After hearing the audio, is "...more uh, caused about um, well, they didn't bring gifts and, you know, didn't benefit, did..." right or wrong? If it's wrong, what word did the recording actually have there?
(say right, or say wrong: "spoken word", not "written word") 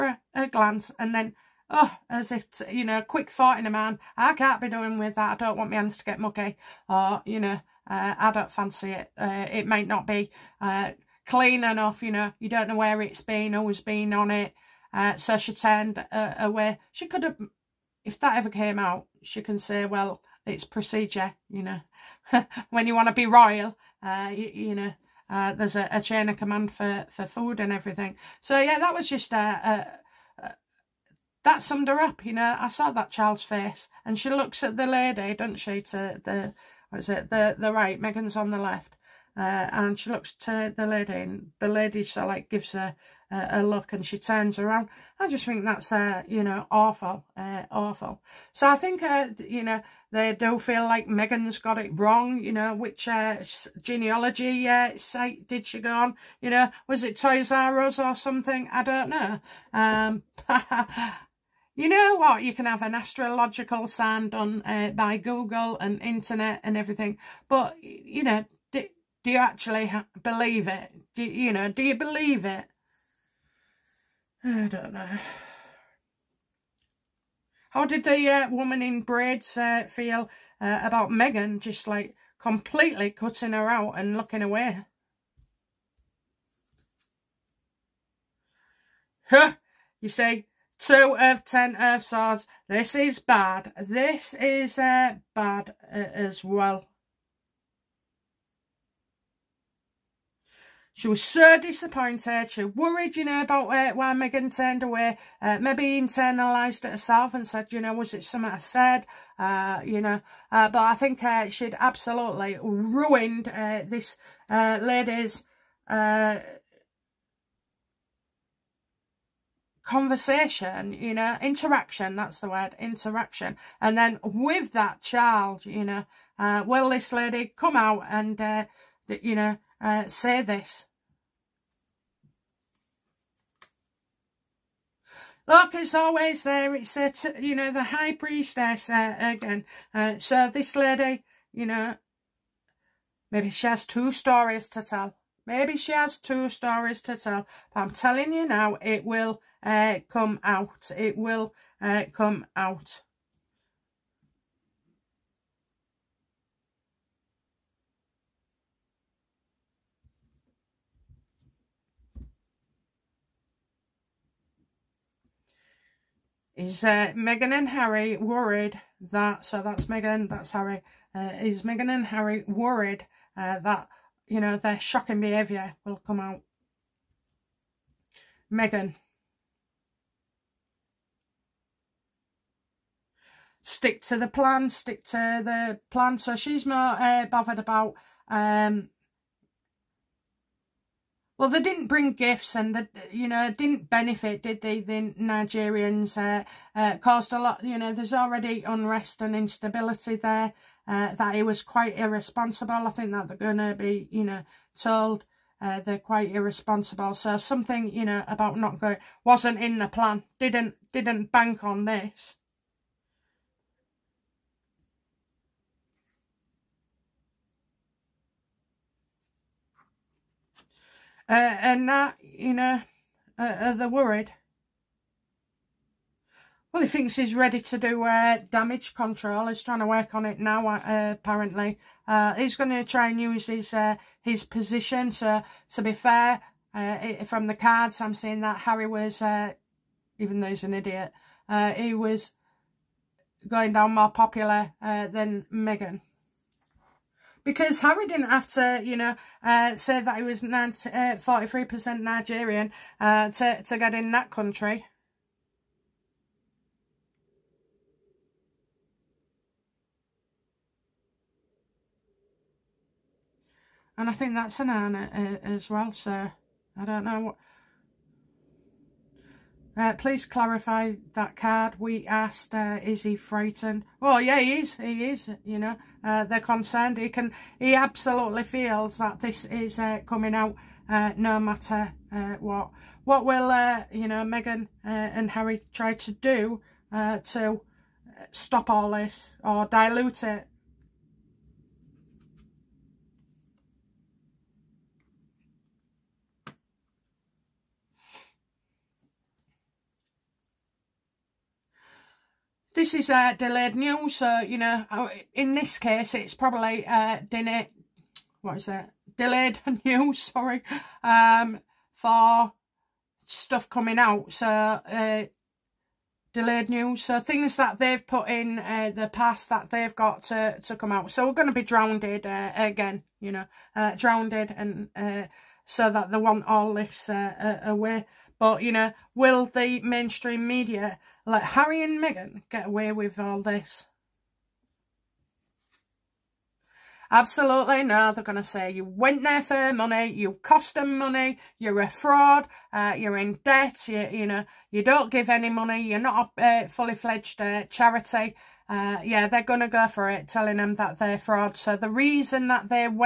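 wrong: "bothered", not "caused".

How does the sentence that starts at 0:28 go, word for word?
So yeah, that was just a, uh, uh, uh, that summed her up.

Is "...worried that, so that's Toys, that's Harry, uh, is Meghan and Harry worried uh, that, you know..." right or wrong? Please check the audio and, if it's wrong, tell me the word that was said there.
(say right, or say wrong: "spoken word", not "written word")
wrong: "Meghan", not "Toys".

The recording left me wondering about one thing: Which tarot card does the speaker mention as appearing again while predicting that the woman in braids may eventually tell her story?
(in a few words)
The High Priestess.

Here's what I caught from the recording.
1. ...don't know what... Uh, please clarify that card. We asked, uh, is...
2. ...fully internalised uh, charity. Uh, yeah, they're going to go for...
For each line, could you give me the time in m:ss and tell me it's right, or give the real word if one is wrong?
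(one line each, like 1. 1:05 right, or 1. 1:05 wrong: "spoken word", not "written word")
1. 4:26 right
2. 5:46 wrong: "fledged", not "internalised".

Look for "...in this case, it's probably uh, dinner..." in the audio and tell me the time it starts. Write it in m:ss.
5:05.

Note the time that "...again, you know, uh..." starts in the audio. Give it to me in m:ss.
5:22.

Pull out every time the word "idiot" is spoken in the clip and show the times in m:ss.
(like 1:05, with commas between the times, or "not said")
4:00.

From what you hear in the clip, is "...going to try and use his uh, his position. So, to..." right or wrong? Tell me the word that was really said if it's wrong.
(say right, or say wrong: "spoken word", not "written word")
right.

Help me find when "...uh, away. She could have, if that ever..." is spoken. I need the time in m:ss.
0:16.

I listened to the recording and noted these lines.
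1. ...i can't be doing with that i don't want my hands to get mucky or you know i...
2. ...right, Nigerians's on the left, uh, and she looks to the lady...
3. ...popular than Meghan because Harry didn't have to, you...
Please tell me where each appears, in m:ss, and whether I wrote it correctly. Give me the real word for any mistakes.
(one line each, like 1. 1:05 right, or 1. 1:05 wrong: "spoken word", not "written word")
1. 0:04 right
2. 0:37 wrong: "Meghan", not "Nigerians"
3. 4:04 right.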